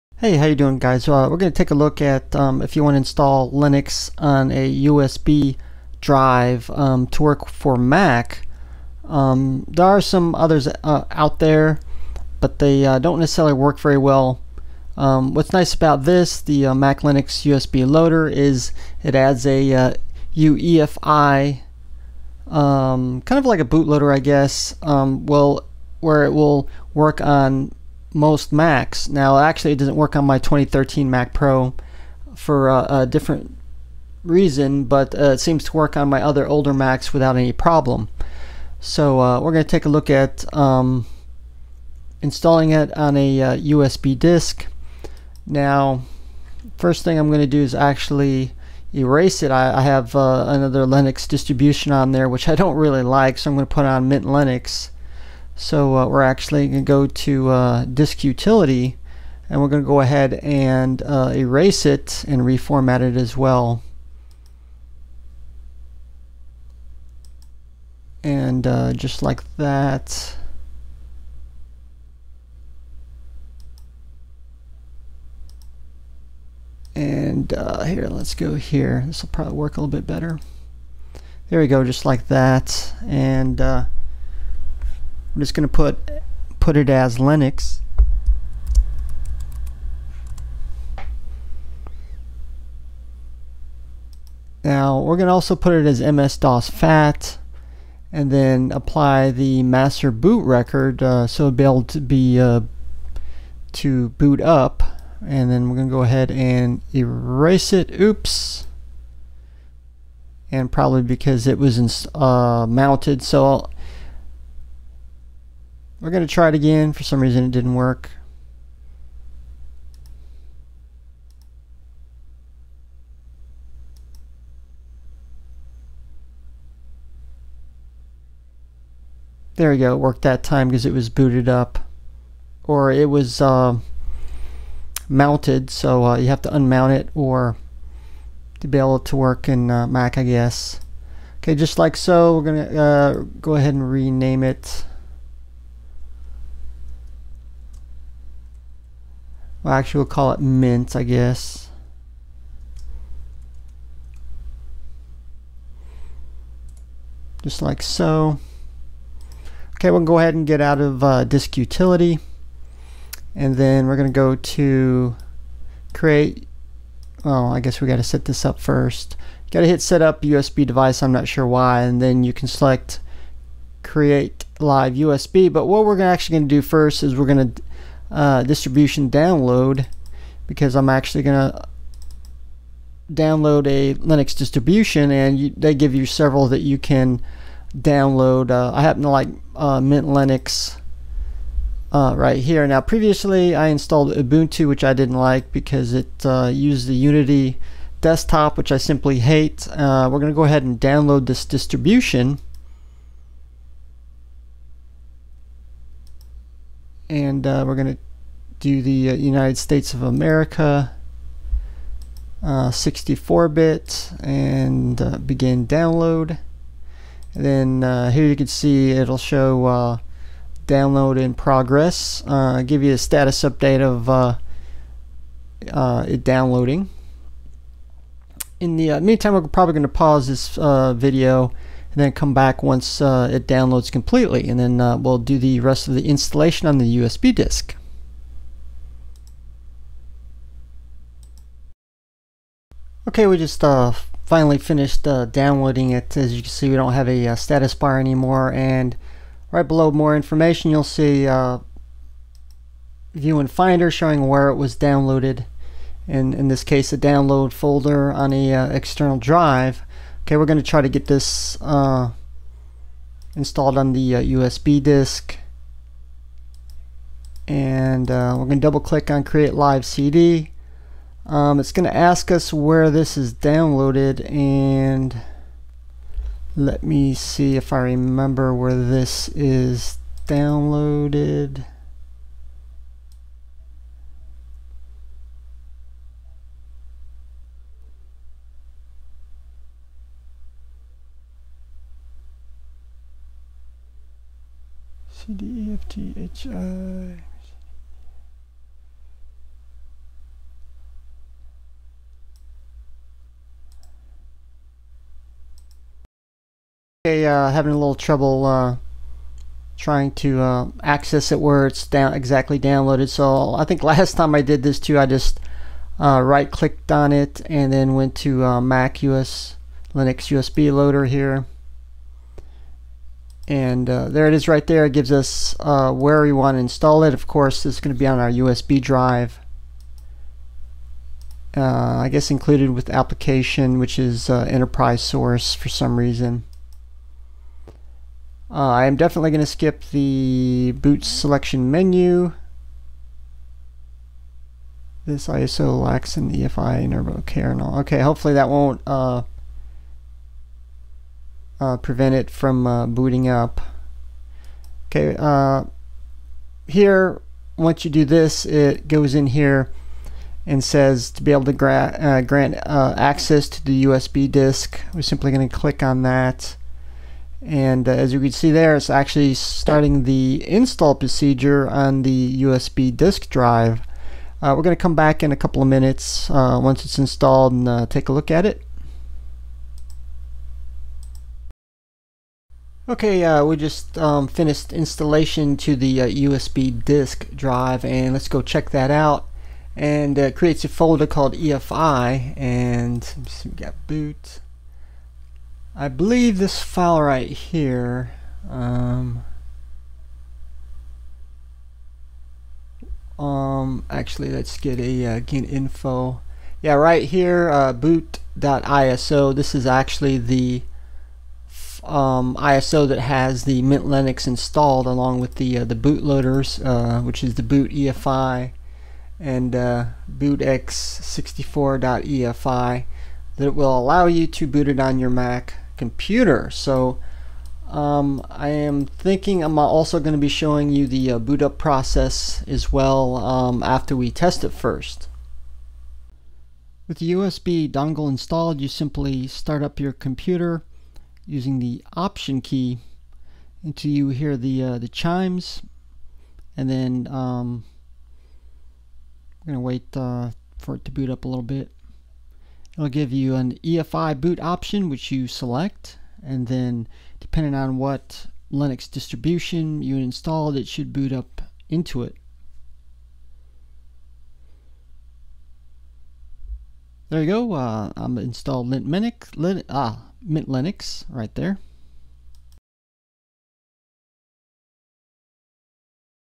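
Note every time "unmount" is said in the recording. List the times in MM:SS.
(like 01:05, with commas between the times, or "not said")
02:16.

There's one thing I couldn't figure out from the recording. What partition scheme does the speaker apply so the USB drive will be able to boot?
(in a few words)
master boot record.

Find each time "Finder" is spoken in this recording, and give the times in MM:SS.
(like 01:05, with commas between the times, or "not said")
04:13.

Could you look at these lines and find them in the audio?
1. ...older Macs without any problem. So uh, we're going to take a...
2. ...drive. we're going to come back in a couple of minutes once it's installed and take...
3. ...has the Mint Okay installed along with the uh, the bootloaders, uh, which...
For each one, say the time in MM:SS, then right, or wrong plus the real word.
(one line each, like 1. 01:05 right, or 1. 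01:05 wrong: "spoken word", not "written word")
1. 00:36 right
2. 06:13 right
3. 06:52 wrong: "Linux", not "Okay".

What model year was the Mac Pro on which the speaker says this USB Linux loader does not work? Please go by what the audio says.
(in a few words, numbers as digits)
2013.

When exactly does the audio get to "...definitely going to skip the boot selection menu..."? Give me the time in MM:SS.
05:38.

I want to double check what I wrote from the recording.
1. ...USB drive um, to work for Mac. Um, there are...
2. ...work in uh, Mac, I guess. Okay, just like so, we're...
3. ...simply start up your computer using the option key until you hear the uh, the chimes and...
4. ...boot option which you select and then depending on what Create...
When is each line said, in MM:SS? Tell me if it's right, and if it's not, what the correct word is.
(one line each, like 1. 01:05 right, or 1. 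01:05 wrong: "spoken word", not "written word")
1. 00:04 right
2. 02:19 right
3. 07:18 right
4. 07:34 wrong: "Linux", not "Create".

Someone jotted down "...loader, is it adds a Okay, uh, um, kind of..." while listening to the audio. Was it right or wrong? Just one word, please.
wrong.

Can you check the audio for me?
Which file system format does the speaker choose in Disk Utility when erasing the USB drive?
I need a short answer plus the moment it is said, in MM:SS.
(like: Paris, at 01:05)
MS-DOS FAT, at 01:36.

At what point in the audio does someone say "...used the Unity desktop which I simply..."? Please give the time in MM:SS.
03:16.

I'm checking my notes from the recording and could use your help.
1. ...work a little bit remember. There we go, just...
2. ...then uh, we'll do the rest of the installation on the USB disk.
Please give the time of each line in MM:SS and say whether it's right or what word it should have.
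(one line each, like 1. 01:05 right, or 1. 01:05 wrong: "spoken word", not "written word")
1. 01:19 wrong: "better", not "remember"
2. 03:54 right.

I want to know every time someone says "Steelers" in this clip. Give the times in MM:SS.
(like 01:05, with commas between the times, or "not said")
not said.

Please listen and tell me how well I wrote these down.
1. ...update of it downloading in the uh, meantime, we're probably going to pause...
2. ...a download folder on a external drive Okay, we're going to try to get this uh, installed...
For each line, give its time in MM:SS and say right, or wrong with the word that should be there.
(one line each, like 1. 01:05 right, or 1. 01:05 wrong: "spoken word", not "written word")
1. 03:43 right
2. 04:16 right.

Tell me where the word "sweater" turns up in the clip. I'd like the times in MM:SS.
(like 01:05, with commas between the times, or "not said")
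not said.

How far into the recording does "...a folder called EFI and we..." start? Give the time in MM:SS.
06:30.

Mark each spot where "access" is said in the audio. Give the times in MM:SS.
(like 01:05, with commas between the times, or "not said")
05:10, 06:02.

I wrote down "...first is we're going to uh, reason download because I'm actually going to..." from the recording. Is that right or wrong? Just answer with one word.
wrong.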